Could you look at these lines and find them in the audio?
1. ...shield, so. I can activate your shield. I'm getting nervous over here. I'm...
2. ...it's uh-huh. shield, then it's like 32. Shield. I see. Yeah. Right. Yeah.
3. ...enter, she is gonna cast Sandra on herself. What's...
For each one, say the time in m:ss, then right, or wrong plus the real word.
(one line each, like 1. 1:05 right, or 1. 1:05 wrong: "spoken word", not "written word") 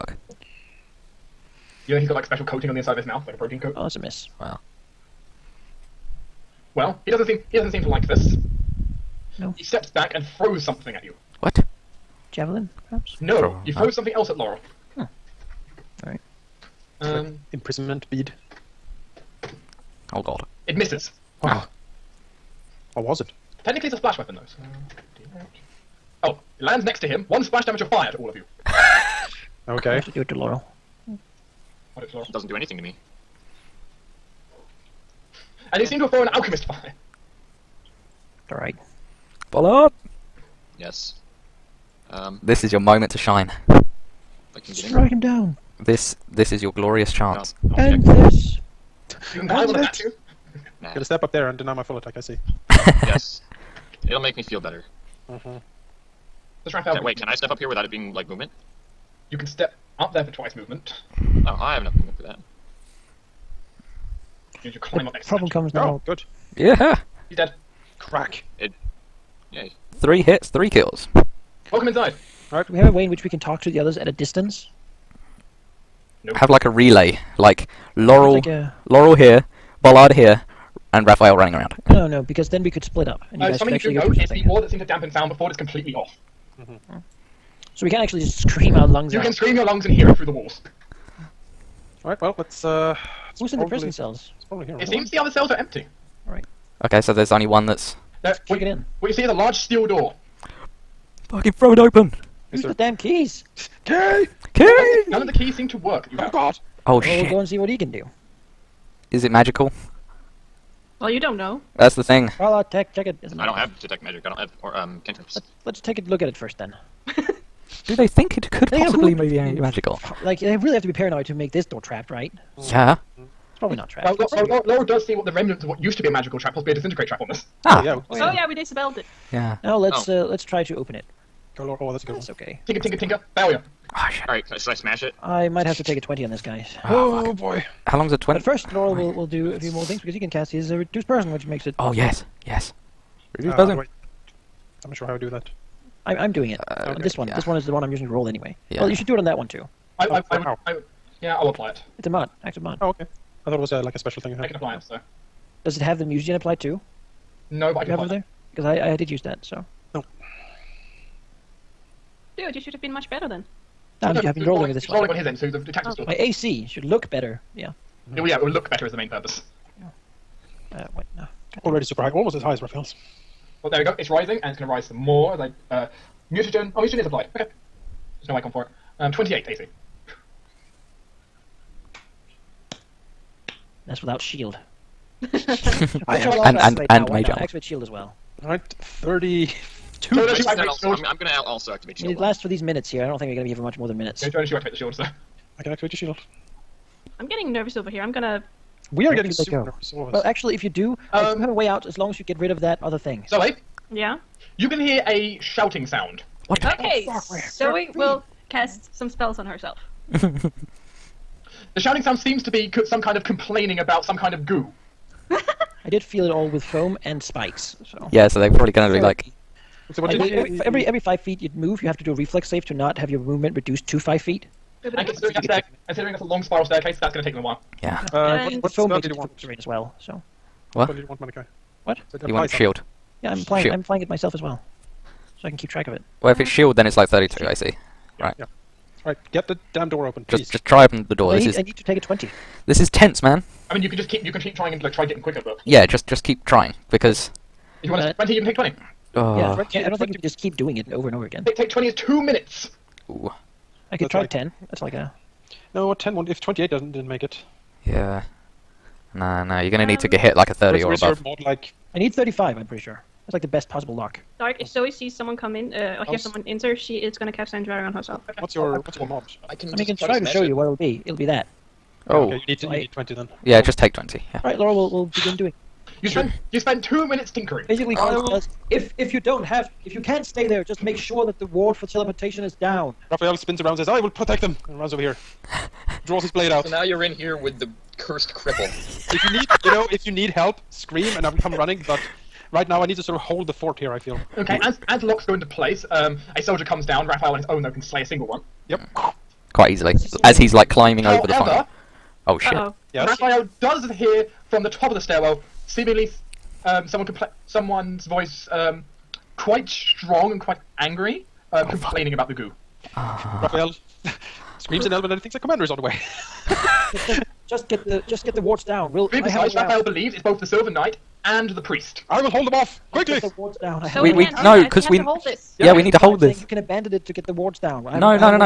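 1. 3:14 right
2. 3:56 right
3. 4:26 right.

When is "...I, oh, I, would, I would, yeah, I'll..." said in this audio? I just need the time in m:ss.
2:30.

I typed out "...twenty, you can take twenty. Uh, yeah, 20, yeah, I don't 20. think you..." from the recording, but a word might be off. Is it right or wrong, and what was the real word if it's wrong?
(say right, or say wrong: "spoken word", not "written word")
right.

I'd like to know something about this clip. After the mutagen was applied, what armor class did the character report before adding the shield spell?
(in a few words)
28.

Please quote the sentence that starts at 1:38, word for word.
What you see is a large steel door.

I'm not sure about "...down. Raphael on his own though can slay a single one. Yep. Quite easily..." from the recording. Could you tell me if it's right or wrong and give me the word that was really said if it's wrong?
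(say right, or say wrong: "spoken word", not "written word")
right.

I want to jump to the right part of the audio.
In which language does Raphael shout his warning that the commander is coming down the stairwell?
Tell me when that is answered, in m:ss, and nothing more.
5:14.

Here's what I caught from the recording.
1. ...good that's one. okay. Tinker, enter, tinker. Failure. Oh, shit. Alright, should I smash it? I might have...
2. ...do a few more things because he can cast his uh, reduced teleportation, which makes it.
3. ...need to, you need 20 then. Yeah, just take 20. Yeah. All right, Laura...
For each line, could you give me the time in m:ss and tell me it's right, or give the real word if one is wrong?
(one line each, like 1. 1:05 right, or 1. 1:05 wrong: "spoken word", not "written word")
1. 2:12 wrong: "tinker", not "enter"
2. 2:19 wrong: "person", not "teleportation"
3. 4:32 right.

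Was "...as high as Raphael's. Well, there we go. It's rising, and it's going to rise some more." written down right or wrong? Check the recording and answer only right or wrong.
right.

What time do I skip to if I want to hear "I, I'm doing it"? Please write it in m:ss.
2:26.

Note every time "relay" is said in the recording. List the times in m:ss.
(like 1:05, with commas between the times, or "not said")
1:16.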